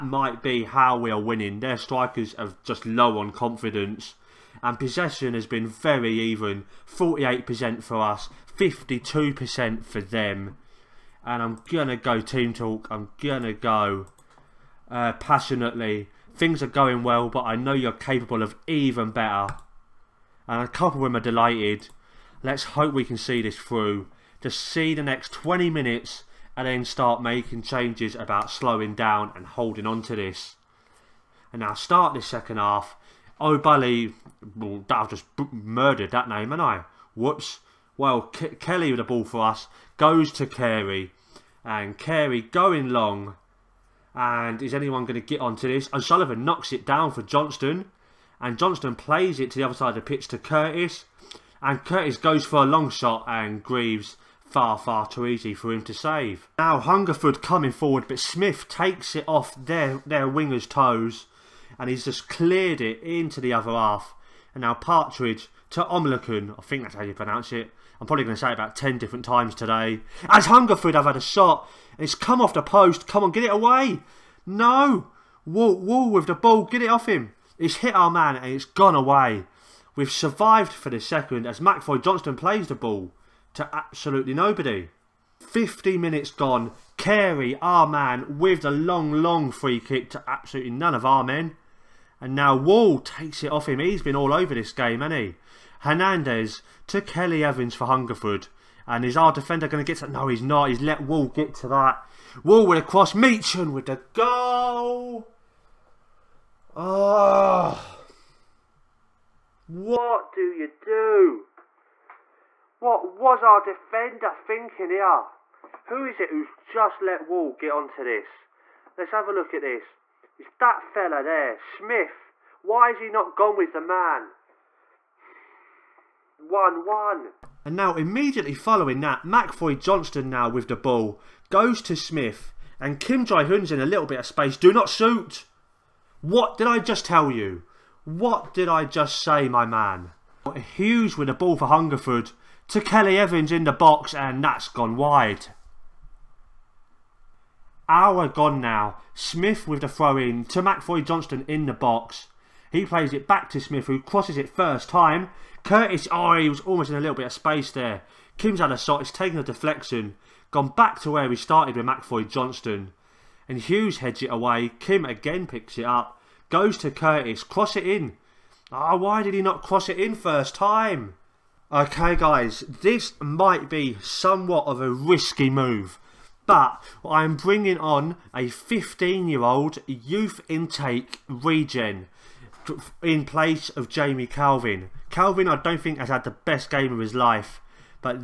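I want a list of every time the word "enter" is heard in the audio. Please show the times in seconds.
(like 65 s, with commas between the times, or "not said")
not said.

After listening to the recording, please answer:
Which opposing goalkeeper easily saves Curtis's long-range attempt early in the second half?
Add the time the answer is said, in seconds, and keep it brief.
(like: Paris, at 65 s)
Greaves, at 53 s.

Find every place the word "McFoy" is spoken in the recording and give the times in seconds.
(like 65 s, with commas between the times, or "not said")
81 s, 129 s, 150 s, 161 s.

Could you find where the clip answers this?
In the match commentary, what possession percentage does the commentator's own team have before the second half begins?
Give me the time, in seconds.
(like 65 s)
6 s.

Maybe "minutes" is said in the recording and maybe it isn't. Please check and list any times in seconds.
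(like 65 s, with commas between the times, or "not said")
25 s, 85 s.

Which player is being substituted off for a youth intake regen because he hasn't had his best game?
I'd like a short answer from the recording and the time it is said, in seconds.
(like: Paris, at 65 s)
Jamie Calvin, at 183 s.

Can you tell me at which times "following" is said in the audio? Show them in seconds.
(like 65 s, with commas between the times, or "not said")
128 s.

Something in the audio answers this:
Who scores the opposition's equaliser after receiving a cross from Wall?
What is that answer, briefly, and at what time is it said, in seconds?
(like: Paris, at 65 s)
Meechan, at 103 s.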